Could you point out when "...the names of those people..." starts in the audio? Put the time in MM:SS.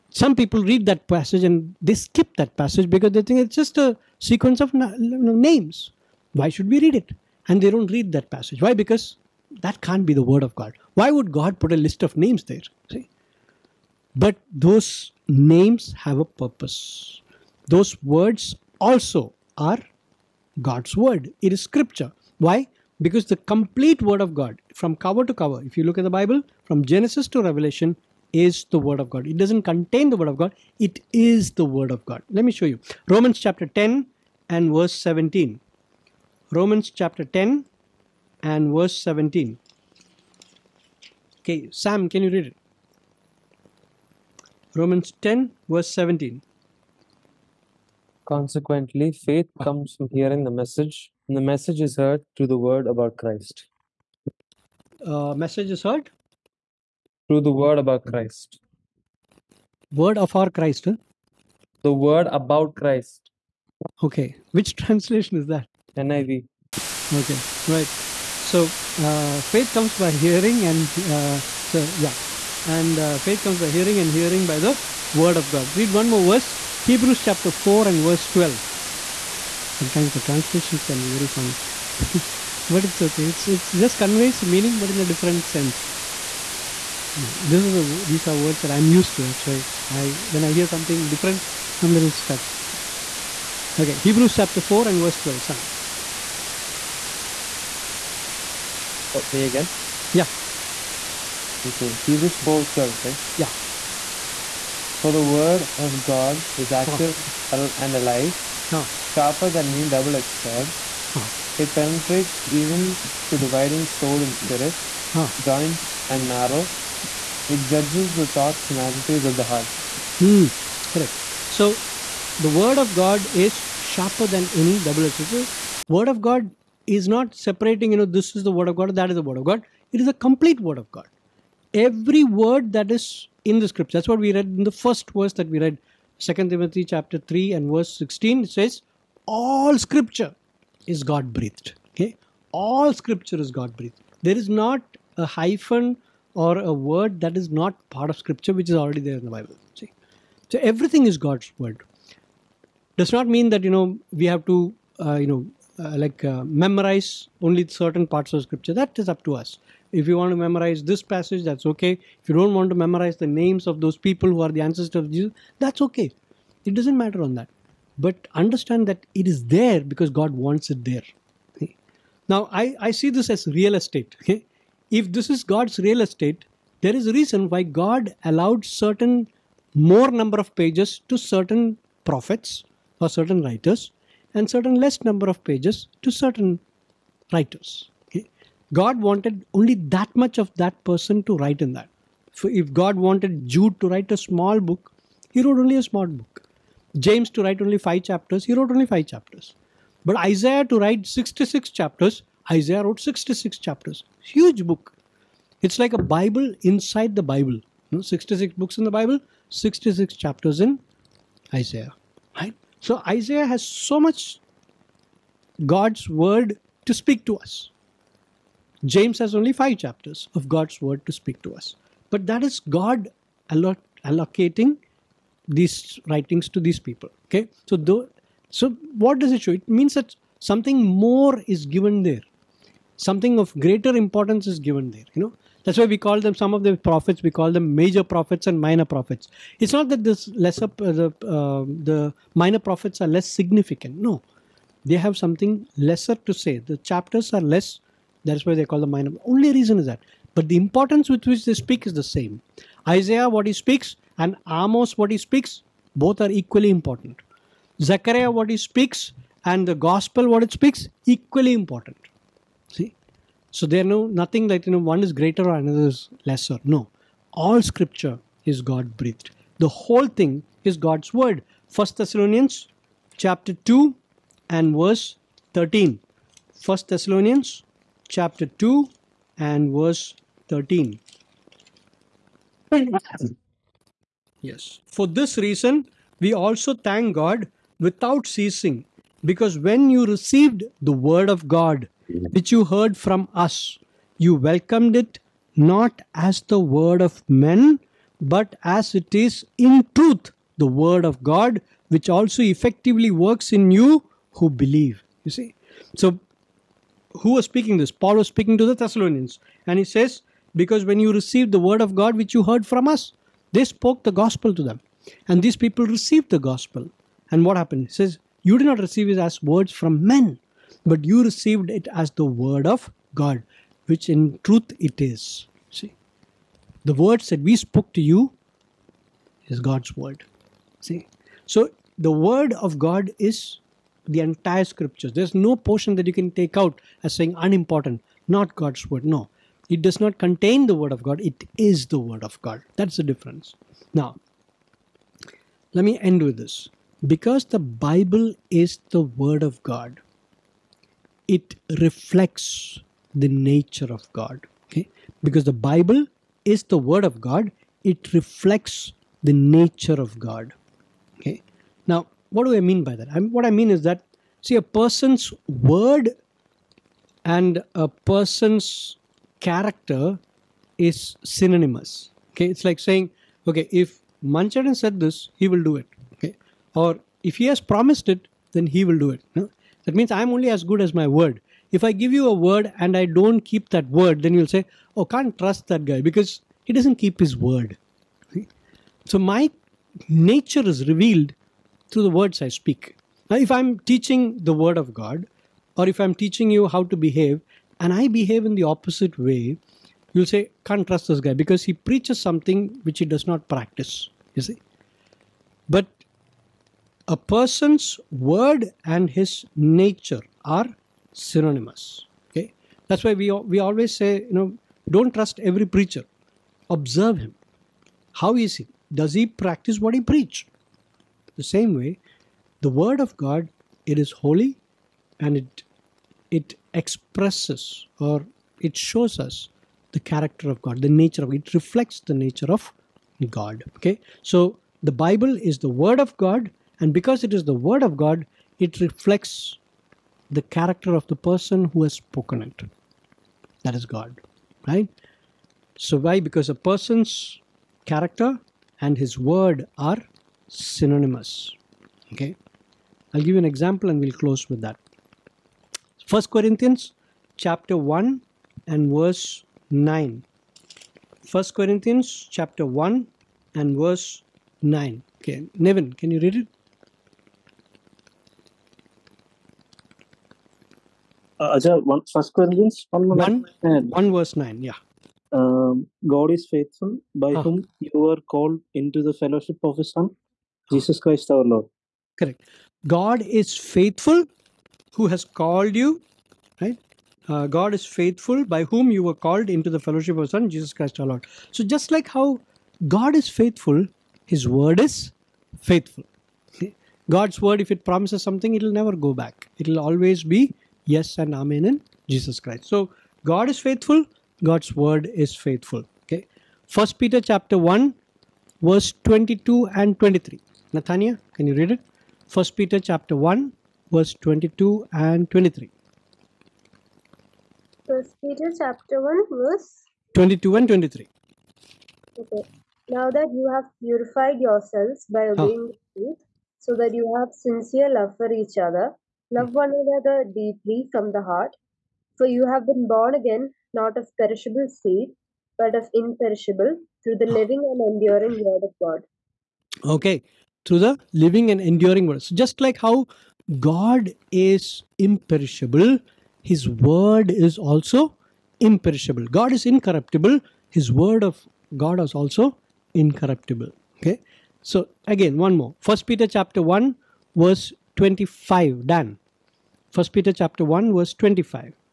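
02:43.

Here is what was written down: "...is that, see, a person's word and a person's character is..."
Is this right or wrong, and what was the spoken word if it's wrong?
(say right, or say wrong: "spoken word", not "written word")
right.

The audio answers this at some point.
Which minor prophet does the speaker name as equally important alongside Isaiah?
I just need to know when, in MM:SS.
04:14.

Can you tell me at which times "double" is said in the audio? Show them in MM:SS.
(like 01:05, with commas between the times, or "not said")
01:49, 02:04.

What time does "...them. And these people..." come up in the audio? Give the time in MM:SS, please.
05:14.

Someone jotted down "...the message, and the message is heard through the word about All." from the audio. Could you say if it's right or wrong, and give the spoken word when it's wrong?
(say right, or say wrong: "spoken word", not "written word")
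wrong: "Christ", not "All".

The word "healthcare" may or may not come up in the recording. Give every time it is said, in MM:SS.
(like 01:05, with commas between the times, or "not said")
not said.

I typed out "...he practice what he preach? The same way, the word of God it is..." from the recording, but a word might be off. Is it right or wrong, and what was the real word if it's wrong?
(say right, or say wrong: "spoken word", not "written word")
right.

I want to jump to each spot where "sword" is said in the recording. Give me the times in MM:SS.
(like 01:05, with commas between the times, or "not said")
01:50, 02:05.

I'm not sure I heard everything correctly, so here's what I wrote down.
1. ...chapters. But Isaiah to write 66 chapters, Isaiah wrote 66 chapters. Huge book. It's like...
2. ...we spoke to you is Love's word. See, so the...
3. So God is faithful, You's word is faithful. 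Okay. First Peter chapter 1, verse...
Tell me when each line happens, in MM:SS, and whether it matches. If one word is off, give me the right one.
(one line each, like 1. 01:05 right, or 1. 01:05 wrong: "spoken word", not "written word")
1. 03:19 right
2. 05:27 wrong: "God", not "Love"
3. 08:22 wrong: "God", not "You".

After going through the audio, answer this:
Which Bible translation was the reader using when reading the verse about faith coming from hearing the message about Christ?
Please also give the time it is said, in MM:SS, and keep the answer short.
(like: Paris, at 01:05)
NIV, at 01:05.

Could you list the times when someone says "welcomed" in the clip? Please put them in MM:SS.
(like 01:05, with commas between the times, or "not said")
04:54.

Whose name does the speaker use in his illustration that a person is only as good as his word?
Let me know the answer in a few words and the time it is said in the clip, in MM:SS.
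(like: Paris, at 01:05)
Mancharan, at 06:14.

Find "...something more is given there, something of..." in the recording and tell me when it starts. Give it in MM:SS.
03:50.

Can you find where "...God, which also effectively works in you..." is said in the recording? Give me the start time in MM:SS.
05:01.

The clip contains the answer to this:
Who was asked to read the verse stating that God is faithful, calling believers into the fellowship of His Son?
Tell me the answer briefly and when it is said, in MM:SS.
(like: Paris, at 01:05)
Nevin, at 07:45.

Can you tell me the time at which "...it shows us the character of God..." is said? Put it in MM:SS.
07:08.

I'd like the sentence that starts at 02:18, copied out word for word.
It says, All scripture is God breathed.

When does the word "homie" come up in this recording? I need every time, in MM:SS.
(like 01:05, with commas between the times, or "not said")
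not said.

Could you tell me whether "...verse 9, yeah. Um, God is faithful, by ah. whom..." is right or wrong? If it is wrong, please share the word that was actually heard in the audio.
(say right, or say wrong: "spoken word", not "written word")
right.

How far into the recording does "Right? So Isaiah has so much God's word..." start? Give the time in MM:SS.
03:32.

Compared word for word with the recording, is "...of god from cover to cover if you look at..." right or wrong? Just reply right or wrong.
right.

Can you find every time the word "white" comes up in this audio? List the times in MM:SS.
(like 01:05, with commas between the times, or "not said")
not said.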